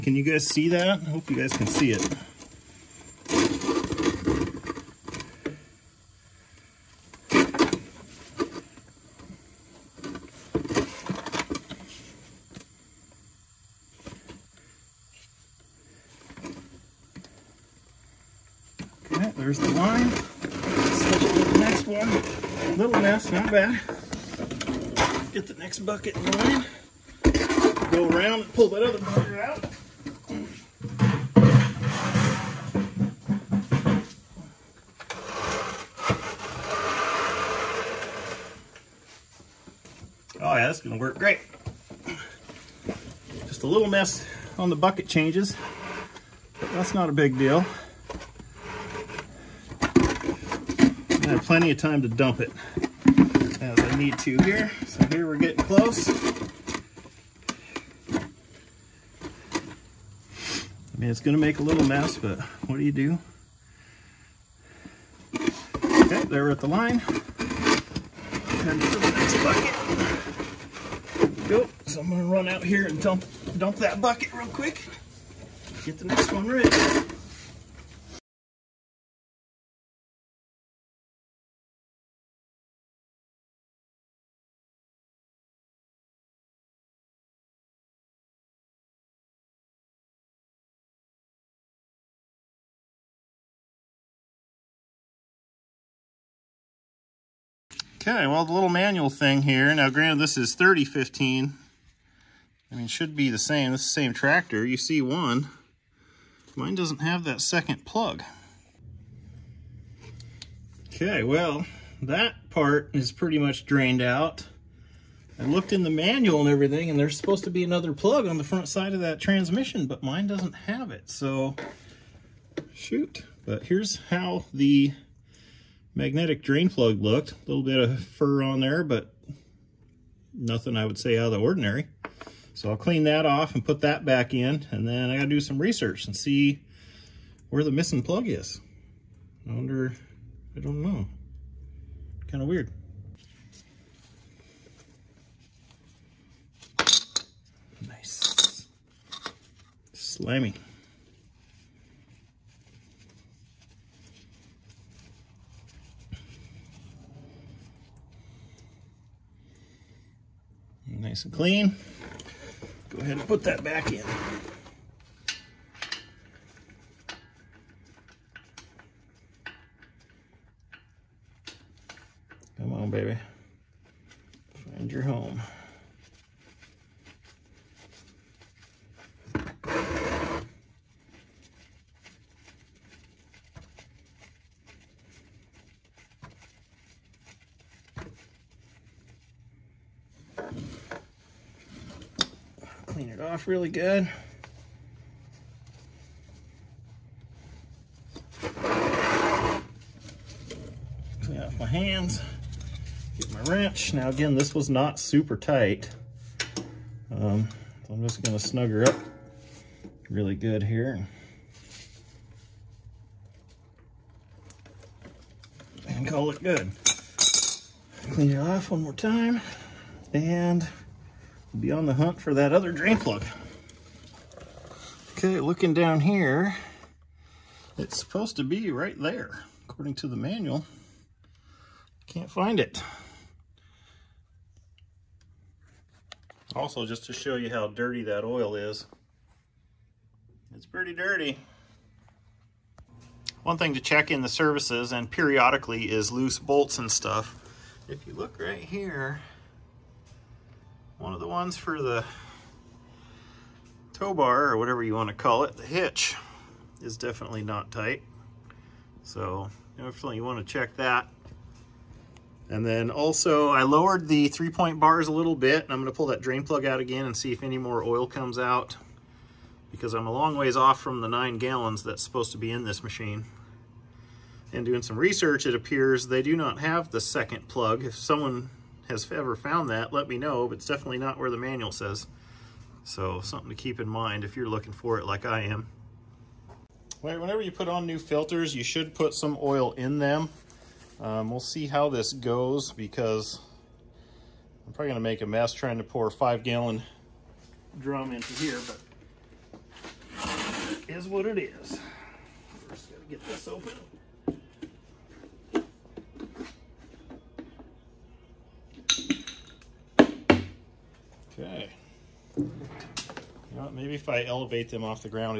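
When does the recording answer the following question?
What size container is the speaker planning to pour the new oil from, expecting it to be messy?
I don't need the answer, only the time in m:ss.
4:56.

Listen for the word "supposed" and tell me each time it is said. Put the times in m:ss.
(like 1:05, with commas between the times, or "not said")
1:57, 3:47, 4:32.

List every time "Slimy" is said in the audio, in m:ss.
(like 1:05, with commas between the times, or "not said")
2:29.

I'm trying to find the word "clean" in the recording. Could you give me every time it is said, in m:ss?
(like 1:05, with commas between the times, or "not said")
2:12, 2:41, 3:18, 3:38.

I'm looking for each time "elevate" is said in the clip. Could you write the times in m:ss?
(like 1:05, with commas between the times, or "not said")
5:14.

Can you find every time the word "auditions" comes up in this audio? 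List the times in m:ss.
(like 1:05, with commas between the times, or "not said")
not said.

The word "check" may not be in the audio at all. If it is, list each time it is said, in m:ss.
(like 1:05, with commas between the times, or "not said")
4:03, 4:20.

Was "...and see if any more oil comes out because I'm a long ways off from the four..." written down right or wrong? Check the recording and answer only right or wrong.
wrong.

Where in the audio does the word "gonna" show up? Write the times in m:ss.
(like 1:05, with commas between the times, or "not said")
0:40, 1:01, 1:12, 3:28, 4:54.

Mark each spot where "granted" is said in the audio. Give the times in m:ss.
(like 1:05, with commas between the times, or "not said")
1:39.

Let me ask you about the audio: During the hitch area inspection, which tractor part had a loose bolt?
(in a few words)
tow bar.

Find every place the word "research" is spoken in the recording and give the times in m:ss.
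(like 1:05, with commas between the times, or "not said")
2:15, 4:34.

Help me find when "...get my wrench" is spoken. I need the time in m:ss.
3:23.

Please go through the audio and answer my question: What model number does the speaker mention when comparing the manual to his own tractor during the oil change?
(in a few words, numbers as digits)
3015.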